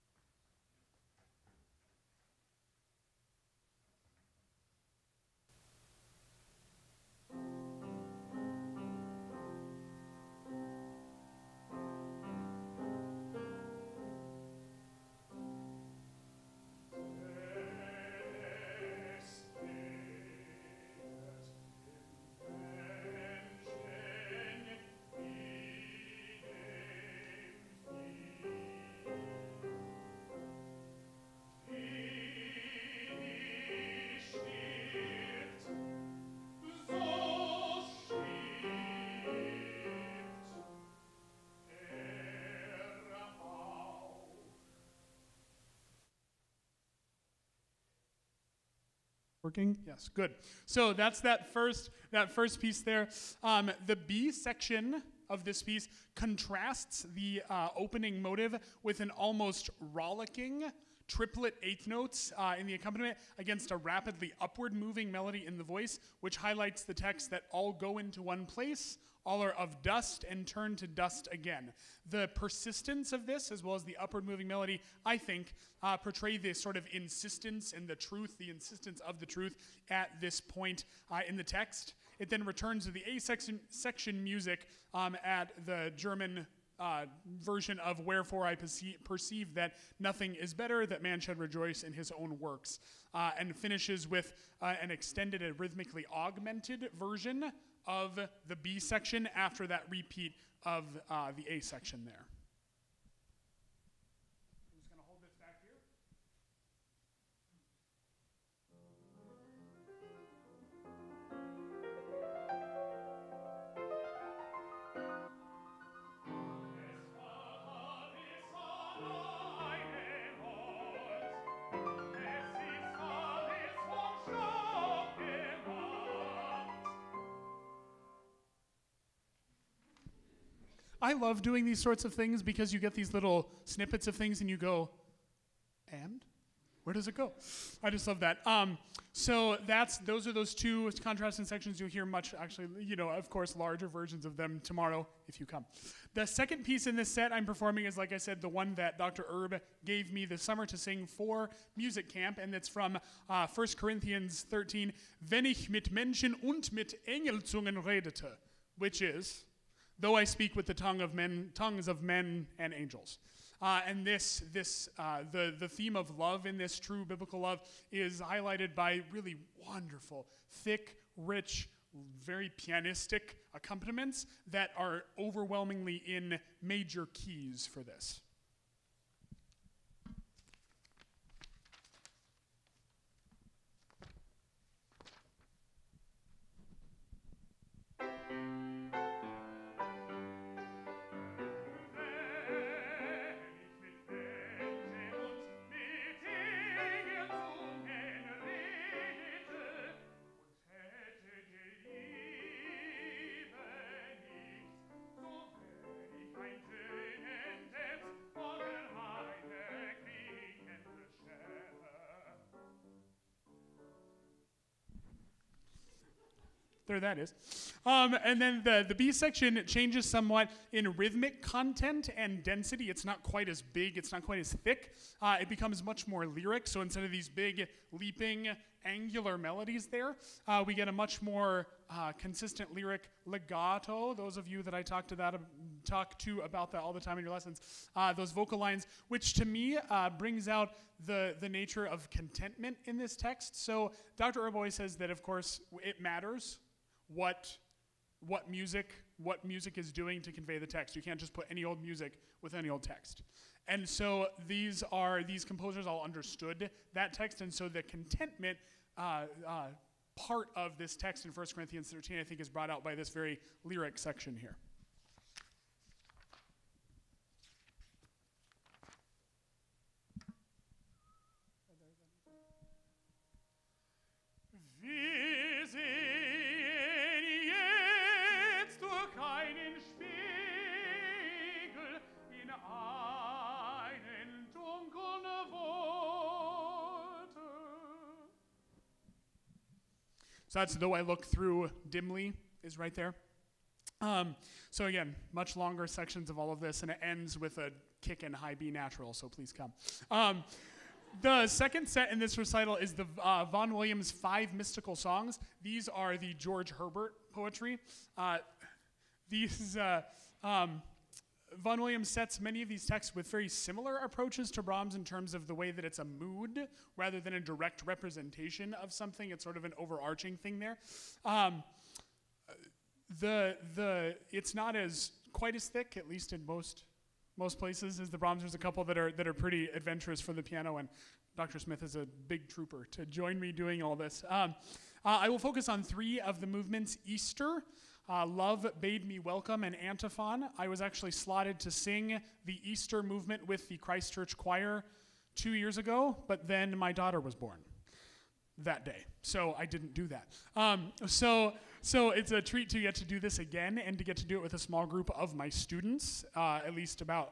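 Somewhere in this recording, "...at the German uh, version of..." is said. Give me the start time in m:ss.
1:25.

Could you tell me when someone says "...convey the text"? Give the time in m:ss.
4:10.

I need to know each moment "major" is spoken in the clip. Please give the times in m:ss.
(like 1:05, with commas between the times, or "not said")
2:56.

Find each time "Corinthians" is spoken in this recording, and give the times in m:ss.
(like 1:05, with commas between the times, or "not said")
2:33, 4:21.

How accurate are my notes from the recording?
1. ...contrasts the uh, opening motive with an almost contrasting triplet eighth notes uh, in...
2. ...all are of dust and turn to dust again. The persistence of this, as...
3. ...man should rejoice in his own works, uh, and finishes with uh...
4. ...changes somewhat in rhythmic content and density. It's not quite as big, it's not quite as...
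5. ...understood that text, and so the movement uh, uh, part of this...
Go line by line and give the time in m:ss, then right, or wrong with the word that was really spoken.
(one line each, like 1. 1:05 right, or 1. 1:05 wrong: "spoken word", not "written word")
1. 0:56 wrong: "rollicking", not "contrasting"
2. 1:09 right
3. 1:31 right
4. 3:39 right
5. 4:16 wrong: "contentment", not "movement".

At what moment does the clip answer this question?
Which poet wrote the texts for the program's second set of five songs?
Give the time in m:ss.
5:06.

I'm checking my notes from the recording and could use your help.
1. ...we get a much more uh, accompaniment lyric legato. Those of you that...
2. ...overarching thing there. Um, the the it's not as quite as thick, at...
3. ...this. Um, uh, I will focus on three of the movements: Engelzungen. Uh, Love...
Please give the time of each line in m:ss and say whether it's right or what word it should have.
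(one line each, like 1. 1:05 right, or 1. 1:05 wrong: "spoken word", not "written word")
1. 3:50 wrong: "consistent", not "accompaniment"
2. 5:19 right
3. 5:33 wrong: "Easter", not "Engelzungen".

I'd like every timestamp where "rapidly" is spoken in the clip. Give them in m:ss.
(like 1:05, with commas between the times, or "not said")
1:03.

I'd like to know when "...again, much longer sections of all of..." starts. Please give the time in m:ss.
4:54.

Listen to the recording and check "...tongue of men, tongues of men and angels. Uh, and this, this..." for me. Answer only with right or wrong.
right.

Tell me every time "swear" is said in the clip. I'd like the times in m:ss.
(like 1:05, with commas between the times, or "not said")
not said.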